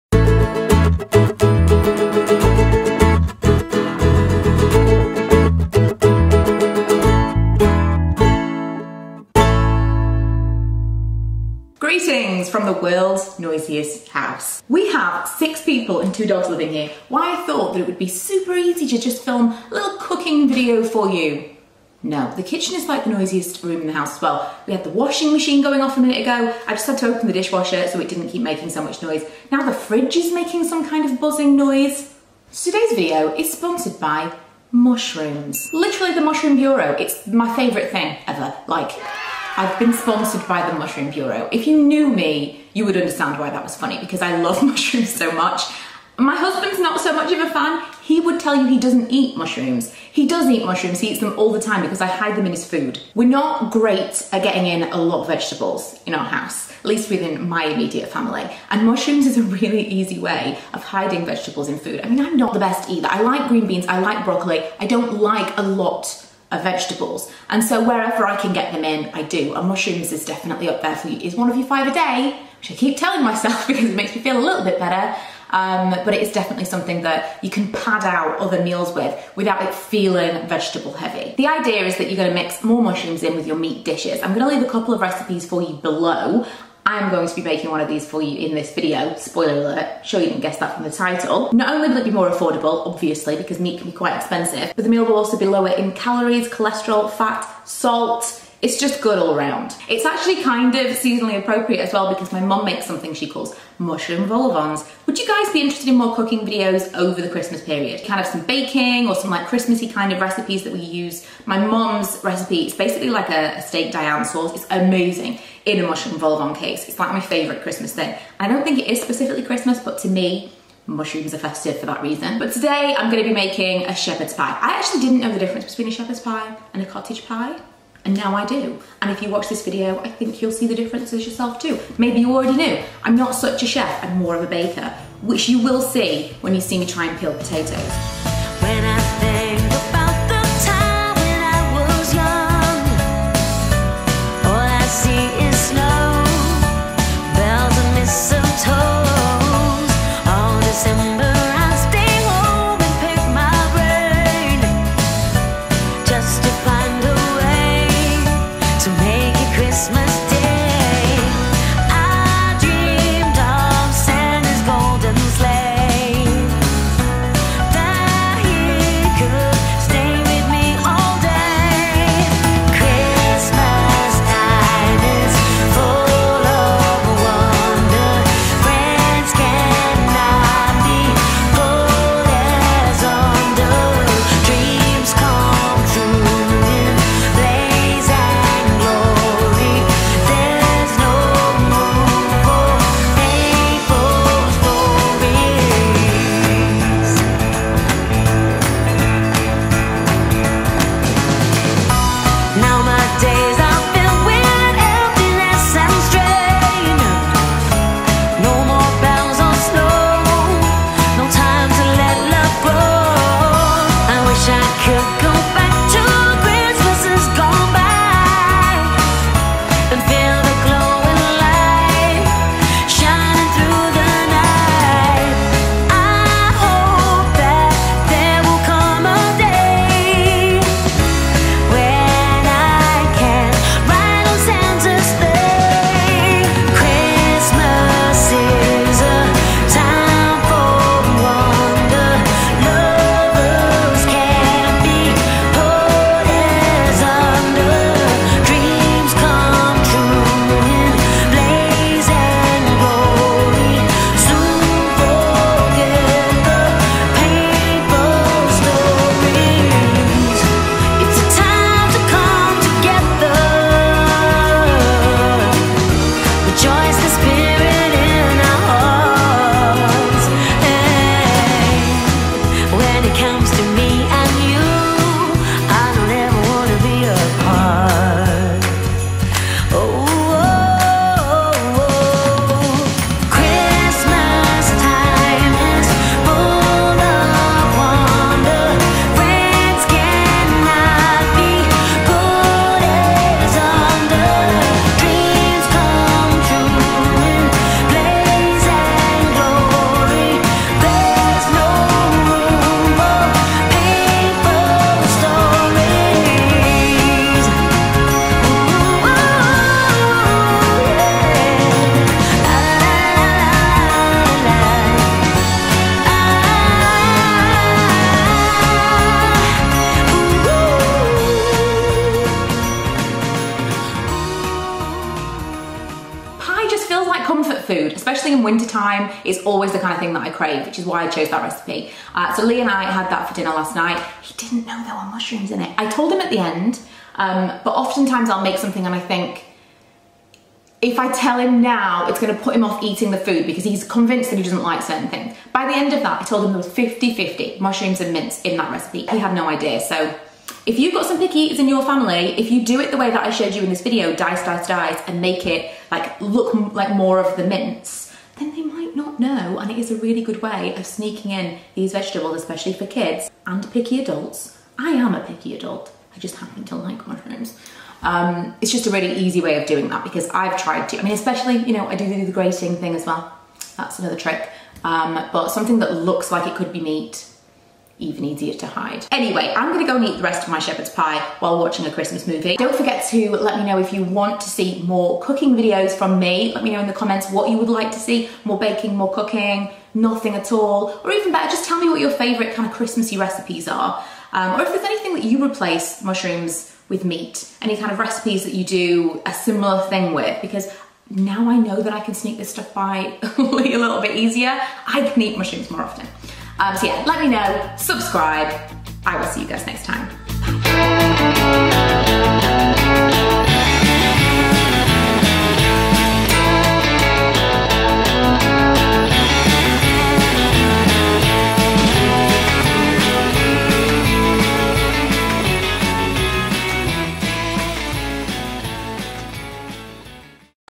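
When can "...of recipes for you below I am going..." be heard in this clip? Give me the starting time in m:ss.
1:24.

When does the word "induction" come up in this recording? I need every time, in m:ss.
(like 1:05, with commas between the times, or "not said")
not said.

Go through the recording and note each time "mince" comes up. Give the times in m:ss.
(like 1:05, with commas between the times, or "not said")
5:48, 5:57.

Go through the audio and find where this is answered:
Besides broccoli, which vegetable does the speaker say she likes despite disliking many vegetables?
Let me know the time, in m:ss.
1:03.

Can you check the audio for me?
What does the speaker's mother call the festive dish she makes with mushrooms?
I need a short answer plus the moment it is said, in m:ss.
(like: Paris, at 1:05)
Mushroom vol-au-vents, at 1:43.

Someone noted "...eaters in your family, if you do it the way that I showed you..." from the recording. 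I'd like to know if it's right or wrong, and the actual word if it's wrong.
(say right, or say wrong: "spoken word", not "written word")
right.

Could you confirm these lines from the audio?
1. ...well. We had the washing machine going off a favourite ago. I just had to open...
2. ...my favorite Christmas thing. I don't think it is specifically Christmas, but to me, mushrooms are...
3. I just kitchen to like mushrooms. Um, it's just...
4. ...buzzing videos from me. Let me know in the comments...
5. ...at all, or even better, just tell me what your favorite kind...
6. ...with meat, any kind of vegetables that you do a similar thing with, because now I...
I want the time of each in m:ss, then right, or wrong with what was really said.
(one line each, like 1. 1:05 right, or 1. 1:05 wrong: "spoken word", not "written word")
1. 0:24 wrong: "minute", not "favourite"
2. 1:57 right
3. 6:06 wrong: "happen", not "kitchen"
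4. 6:25 wrong: "cooking", not "buzzing"
5. 6:30 right
6. 6:36 wrong: "recipes", not "vegetables".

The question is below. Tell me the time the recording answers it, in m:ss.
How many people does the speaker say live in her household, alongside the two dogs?
0:15.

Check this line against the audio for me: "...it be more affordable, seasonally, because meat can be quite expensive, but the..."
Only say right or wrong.
wrong.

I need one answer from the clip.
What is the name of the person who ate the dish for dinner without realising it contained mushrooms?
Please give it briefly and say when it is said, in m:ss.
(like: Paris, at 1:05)
Lee, at 5:32.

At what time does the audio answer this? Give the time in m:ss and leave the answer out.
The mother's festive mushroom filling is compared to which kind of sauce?
1:53.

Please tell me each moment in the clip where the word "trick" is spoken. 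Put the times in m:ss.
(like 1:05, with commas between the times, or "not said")
6:14.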